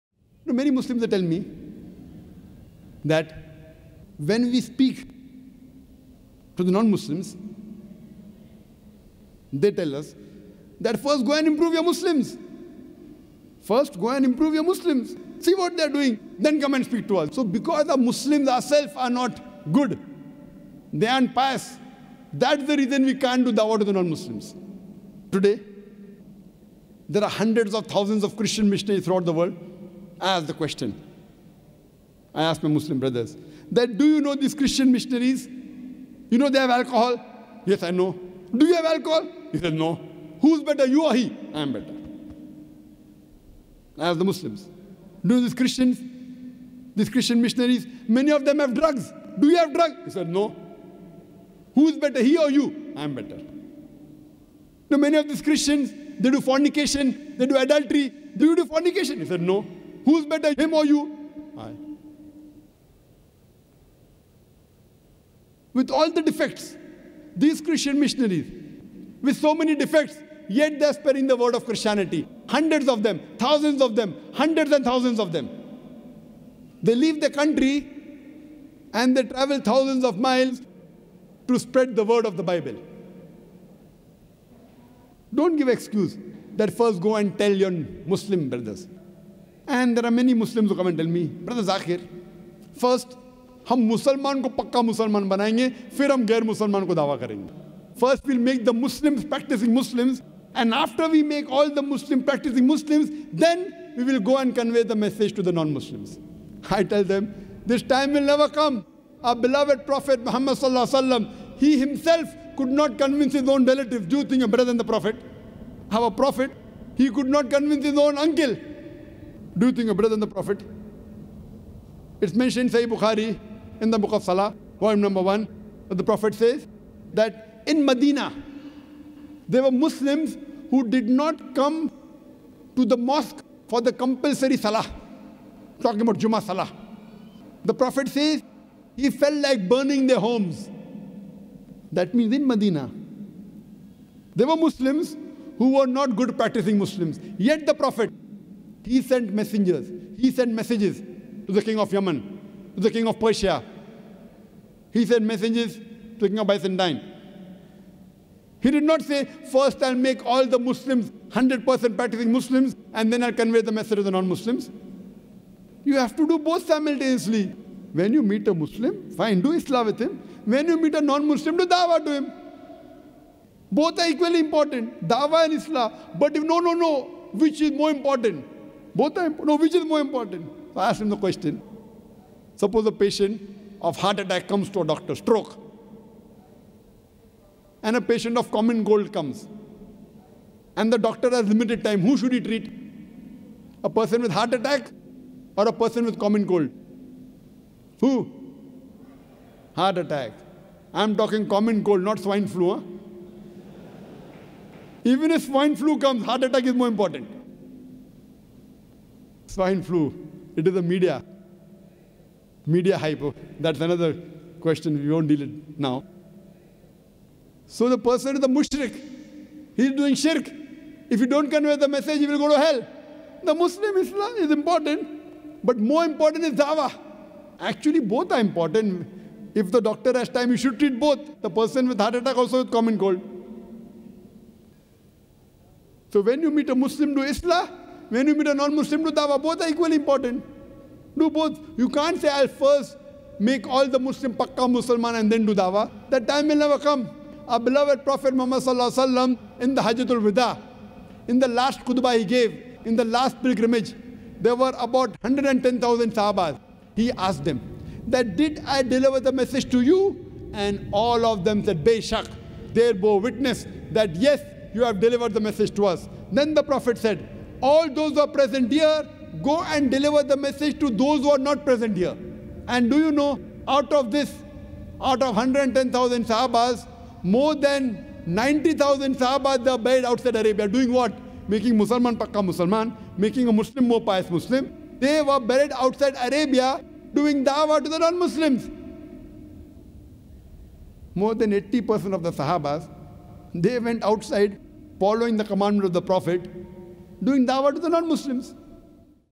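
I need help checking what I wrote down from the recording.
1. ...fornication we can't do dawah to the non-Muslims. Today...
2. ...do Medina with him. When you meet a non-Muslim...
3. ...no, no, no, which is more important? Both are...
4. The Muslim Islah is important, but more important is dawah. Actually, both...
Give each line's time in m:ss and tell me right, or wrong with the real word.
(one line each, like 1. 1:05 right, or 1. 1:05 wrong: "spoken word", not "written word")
1. 0:22 wrong: "reason", not "fornication"
2. 2:49 wrong: "Islah", not "Medina"
3. 2:56 right
4. 3:43 right.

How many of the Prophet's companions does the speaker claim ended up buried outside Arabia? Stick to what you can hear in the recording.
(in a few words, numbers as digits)
More than 90,000.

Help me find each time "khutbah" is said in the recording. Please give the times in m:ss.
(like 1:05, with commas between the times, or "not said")
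4:11.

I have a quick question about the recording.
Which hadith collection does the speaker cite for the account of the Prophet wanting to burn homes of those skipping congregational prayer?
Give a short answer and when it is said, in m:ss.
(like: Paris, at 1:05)
Sahih Bukhari, at 2:02.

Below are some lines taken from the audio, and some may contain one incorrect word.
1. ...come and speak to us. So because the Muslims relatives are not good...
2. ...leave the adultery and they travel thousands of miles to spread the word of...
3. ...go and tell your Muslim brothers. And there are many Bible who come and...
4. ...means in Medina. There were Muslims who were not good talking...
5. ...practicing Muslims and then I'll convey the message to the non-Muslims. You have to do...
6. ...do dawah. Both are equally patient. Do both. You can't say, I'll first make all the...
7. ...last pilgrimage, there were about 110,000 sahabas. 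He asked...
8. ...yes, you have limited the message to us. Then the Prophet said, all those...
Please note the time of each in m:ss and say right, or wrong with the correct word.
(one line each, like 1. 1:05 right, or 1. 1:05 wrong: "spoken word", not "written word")
1. 0:16 wrong: "ourselves", not "relatives"
2. 1:16 wrong: "country", not "adultery"
3. 1:26 wrong: "Muslims", not "Bible"
4. 2:22 wrong: "practicing", not "talking"
5. 2:41 right
6. 3:59 wrong: "important", not "patient"
7. 4:13 right
8. 4:24 wrong: "delivered", not "limited".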